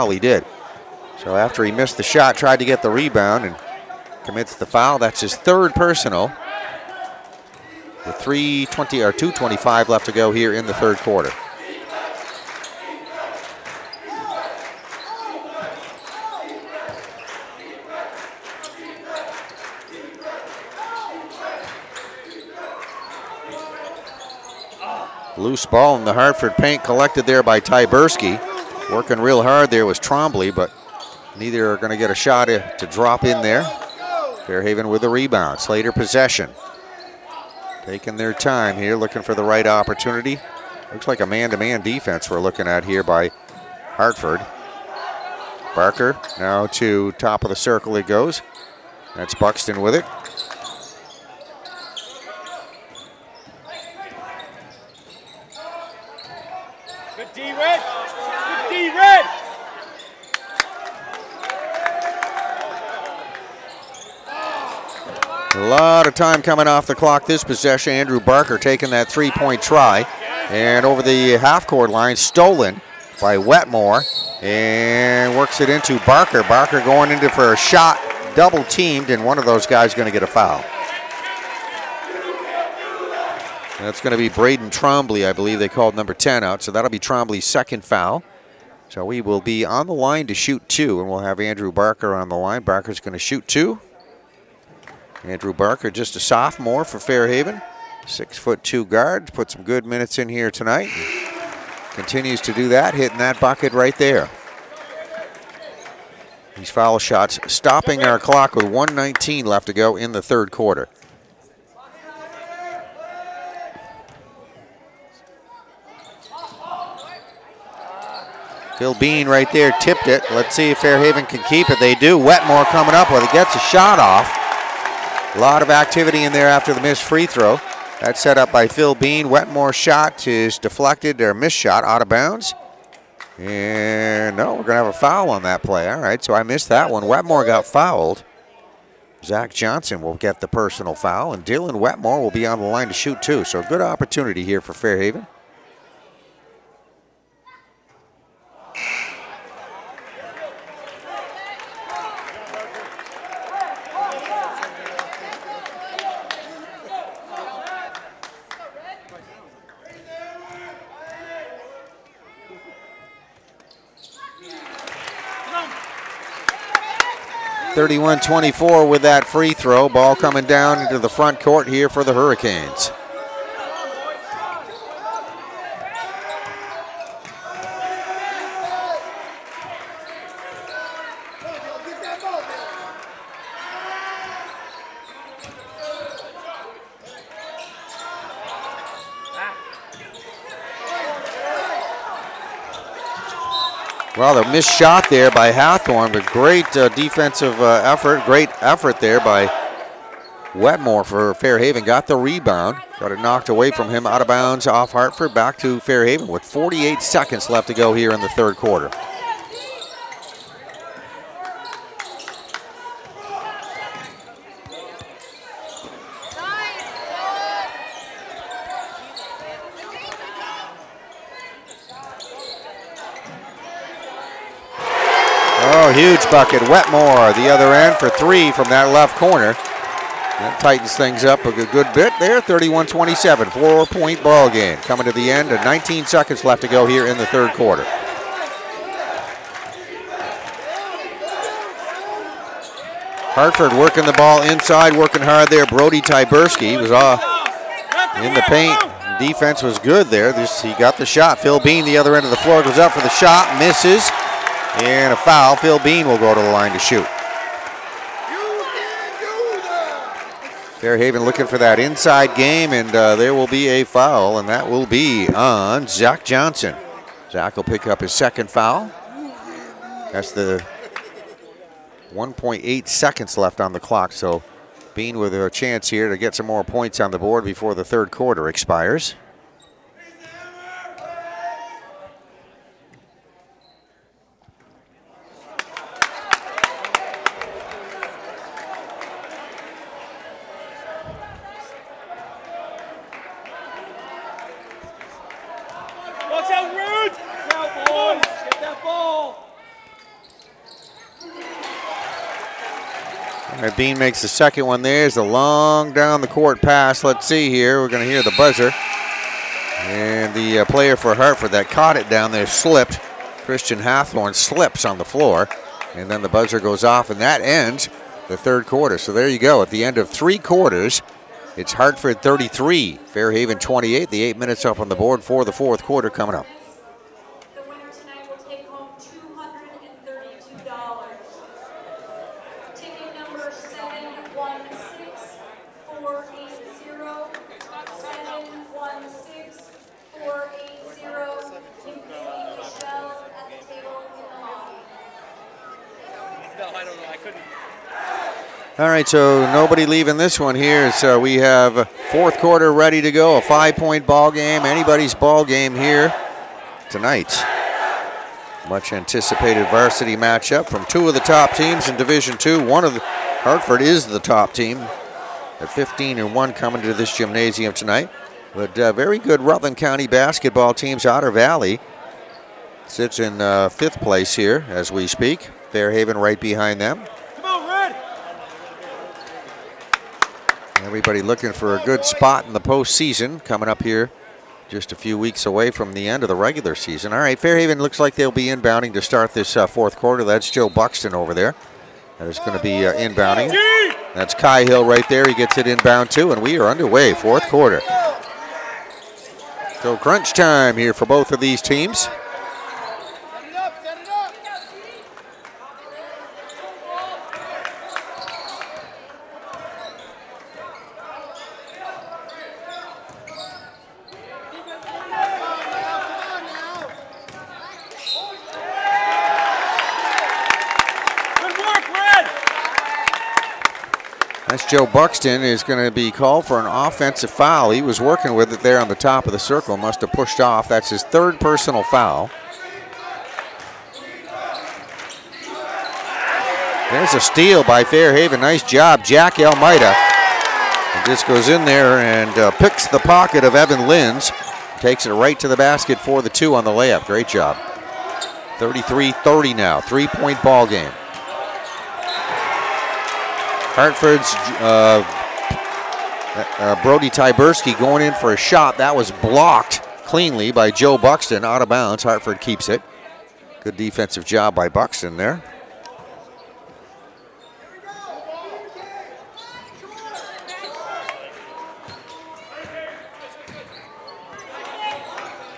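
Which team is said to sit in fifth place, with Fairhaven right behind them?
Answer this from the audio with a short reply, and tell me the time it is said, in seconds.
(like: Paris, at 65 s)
Otter Valley, at 371 s.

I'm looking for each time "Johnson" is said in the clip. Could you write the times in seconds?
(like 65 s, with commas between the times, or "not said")
139 s, 266 s.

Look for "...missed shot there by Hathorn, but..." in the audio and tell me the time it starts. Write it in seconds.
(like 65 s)
194 s.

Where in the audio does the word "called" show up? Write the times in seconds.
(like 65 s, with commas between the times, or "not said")
85 s, 426 s.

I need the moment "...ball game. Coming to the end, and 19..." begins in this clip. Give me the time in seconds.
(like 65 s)
234 s.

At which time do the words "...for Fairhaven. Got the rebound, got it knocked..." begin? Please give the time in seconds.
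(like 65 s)
201 s.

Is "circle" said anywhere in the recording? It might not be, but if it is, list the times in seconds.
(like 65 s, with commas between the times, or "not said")
47 s, 429 s.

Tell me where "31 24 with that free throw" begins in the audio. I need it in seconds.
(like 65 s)
167 s.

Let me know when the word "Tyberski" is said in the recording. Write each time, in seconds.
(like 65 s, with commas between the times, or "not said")
27 s, 246 s, 457 s.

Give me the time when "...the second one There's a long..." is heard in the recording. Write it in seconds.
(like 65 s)
304 s.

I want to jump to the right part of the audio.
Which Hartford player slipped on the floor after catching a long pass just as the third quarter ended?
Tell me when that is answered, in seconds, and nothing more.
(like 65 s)
313 s.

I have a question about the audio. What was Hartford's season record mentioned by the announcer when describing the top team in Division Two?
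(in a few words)
15 and 1.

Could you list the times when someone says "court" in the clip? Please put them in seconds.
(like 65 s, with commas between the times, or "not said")
71 s, 171 s, 306 s.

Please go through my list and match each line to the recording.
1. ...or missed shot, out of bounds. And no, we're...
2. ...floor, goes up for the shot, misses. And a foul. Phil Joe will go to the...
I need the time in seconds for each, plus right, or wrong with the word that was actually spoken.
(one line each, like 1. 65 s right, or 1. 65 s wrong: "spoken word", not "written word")
1. 131 s right
2. 252 s wrong: "Bean", not "Joe".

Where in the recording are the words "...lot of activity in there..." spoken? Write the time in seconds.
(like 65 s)
125 s.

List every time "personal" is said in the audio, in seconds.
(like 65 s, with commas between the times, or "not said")
5 s, 140 s, 431 s.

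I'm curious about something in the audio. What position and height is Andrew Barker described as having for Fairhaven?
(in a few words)
6 foot 2 guard.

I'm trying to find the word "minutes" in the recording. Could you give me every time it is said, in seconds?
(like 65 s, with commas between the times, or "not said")
99 s, 324 s.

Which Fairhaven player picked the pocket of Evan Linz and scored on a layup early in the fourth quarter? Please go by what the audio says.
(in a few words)
Jack Almeida.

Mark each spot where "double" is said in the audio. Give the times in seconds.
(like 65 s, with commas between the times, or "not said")
78 s.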